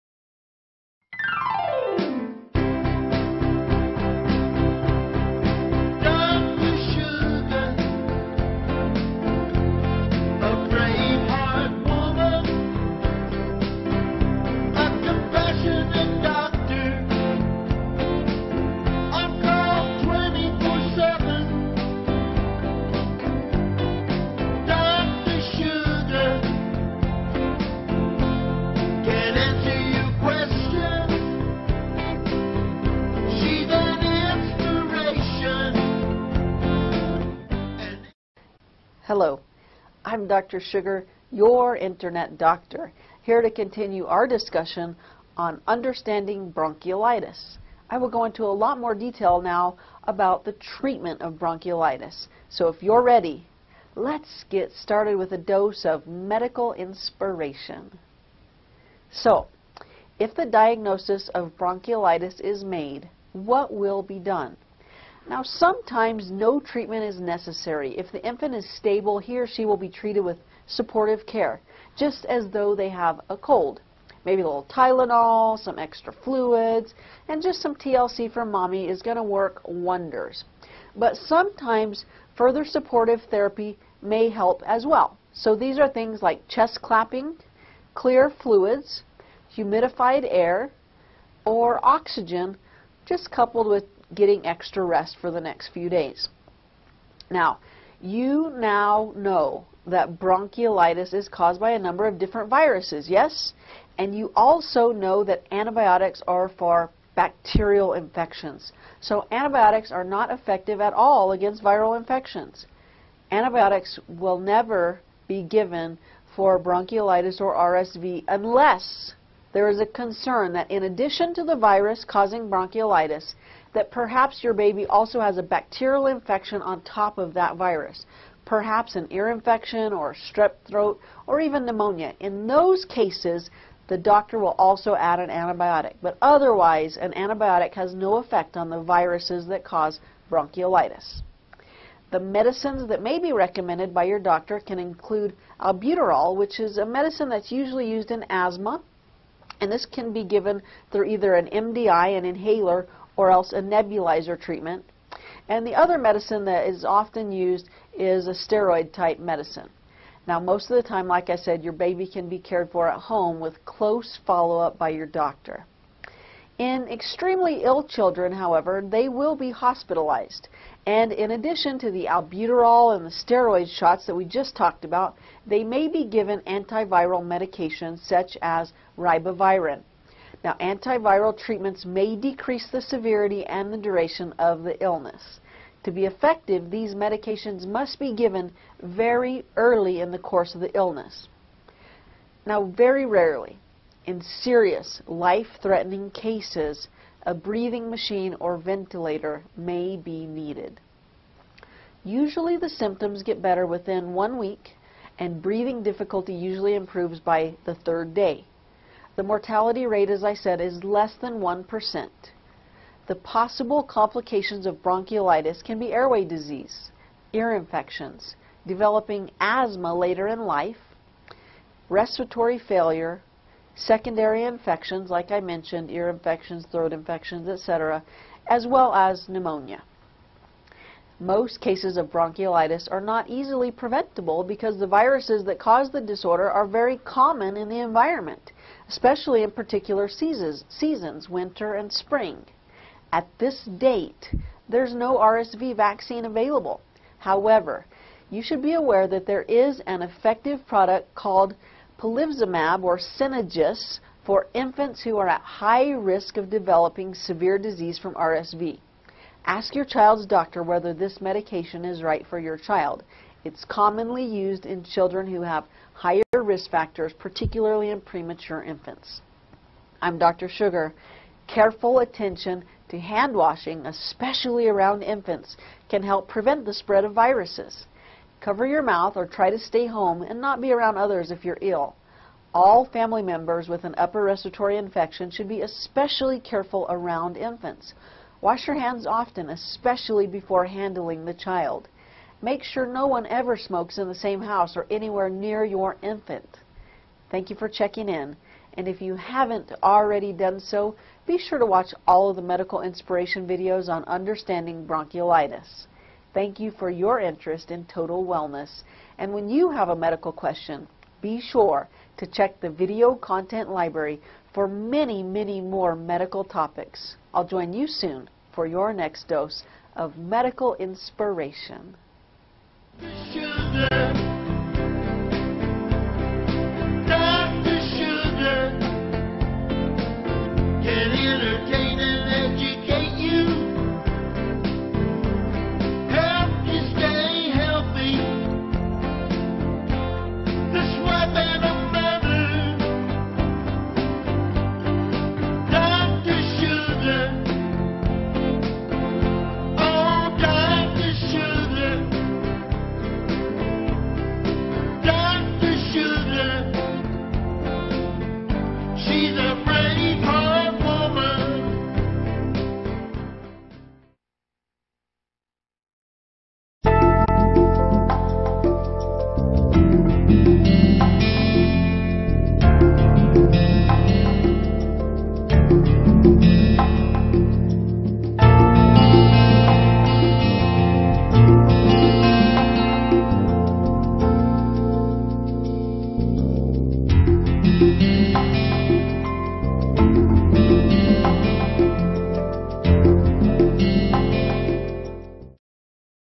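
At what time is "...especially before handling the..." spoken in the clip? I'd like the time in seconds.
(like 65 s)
289 s.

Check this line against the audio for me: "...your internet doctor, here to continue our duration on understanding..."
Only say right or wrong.
wrong.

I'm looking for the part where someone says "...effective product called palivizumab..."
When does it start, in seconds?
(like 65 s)
250 s.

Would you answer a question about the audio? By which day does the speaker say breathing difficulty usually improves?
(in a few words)
third day.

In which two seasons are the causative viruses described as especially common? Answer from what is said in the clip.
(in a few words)
winter and spring.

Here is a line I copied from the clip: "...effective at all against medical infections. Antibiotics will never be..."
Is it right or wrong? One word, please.
wrong.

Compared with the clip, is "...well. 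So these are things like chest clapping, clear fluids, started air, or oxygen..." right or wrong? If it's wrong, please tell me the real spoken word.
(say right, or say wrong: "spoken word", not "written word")
wrong: "humidified", not "started".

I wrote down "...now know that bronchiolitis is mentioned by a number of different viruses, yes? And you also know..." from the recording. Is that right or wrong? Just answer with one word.
wrong.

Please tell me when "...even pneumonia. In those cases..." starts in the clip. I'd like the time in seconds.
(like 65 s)
131 s.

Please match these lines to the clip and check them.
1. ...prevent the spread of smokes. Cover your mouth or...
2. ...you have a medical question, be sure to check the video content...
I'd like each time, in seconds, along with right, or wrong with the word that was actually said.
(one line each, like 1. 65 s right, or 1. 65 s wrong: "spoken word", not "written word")
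1. 276 s wrong: "viruses", not "smokes"
2. 309 s right.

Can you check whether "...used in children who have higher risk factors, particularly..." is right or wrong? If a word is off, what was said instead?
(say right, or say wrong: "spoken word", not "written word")
right.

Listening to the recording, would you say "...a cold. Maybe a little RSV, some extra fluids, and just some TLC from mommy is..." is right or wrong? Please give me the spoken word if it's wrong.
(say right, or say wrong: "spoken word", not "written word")
wrong: "Tylenol", not "RSV".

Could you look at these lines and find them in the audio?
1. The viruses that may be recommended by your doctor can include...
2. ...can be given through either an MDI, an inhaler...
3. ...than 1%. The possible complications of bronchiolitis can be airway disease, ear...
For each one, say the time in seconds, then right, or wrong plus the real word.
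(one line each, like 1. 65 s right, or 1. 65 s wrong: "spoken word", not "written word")
1. 142 s wrong: "medicines", not "viruses"
2. 149 s right
3. 211 s right.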